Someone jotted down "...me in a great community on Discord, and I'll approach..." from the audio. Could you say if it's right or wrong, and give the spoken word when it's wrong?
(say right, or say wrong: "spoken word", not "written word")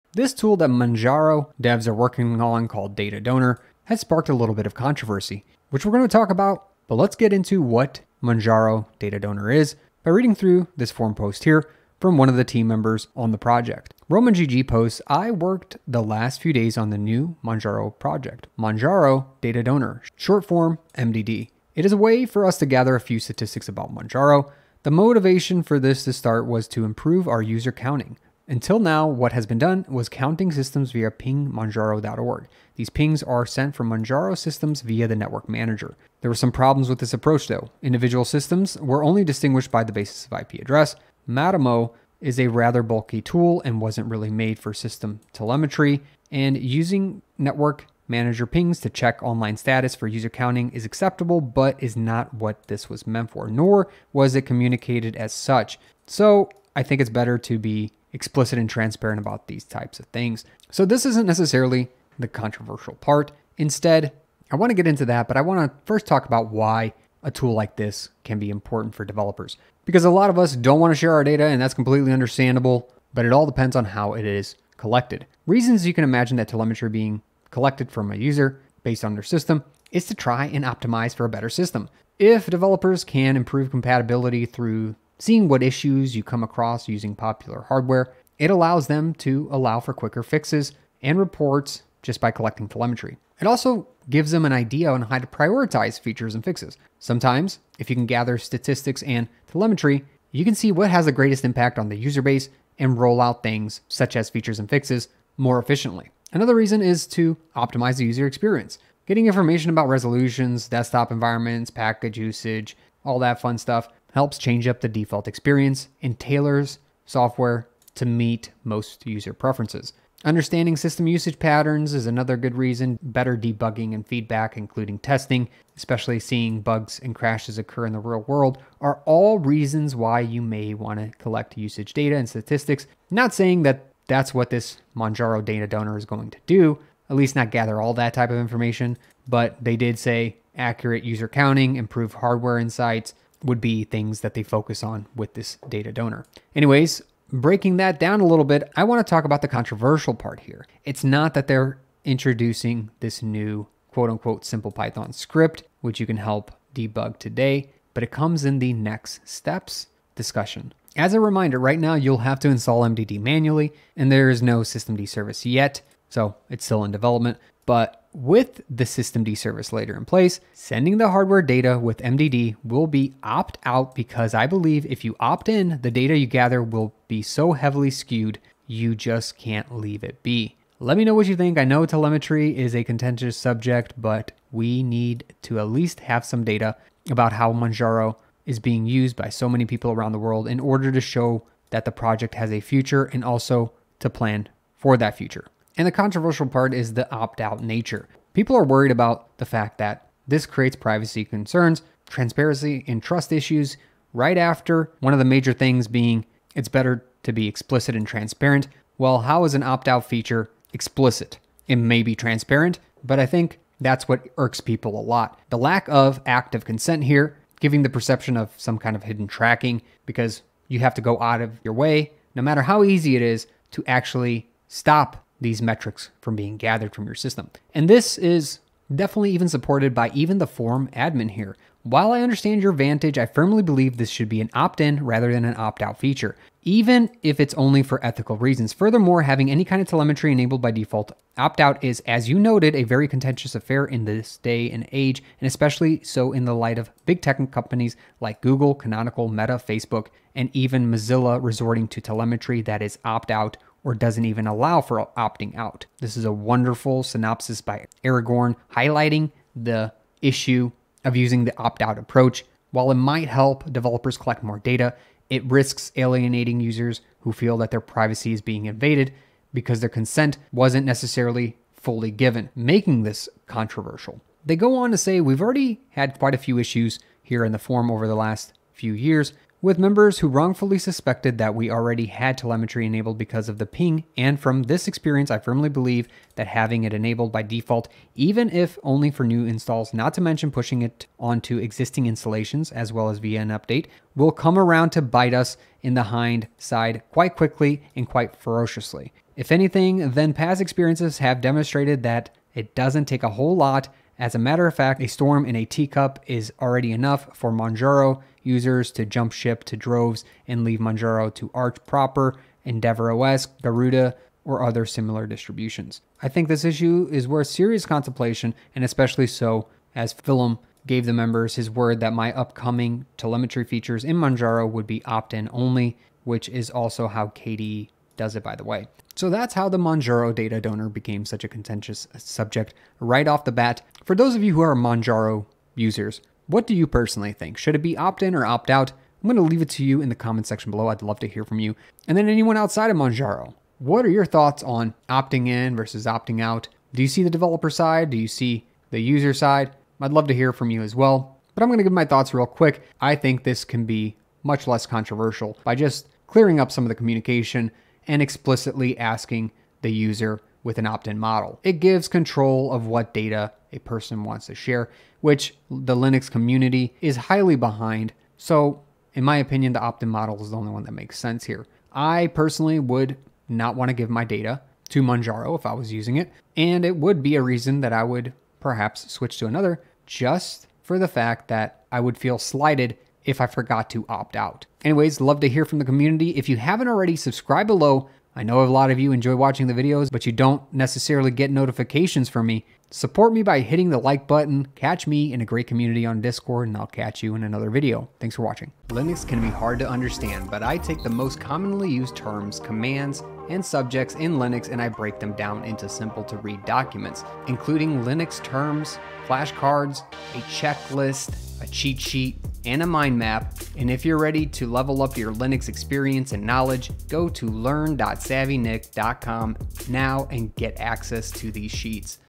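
wrong: "catch", not "approach".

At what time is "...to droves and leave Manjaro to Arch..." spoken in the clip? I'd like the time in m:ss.
5:09.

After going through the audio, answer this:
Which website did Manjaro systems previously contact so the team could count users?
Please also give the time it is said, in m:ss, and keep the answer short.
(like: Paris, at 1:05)
pingmanjaro.org, at 0:31.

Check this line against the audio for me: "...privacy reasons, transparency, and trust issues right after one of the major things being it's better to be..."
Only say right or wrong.
wrong.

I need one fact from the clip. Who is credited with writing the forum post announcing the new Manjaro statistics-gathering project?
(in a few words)
Roman GG.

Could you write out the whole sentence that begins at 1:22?
If developers can improve compatibility through seeing what issues you come across using popular hardware.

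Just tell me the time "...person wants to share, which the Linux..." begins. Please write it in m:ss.
6:03.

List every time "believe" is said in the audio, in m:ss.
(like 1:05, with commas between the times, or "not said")
2:54, 3:53, 4:45.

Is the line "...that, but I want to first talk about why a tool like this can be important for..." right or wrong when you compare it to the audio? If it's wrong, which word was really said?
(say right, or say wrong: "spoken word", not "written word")
right.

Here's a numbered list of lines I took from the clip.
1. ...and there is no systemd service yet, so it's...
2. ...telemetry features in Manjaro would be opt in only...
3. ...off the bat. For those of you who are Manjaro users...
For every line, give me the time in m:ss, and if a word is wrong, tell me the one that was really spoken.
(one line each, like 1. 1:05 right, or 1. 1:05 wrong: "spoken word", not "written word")
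1. 2:43 right
2. 5:23 right
3. 5:33 right.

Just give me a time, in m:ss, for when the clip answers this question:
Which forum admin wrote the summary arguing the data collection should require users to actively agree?
4:18.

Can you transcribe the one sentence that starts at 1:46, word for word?
Another reason is to optimize the user experience.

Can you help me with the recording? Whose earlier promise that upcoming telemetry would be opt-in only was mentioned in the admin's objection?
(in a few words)
philm.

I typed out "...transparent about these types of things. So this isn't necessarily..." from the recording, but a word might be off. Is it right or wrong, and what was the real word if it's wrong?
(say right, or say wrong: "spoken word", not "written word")
right.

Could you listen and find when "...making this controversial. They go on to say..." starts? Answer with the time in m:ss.
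4:32.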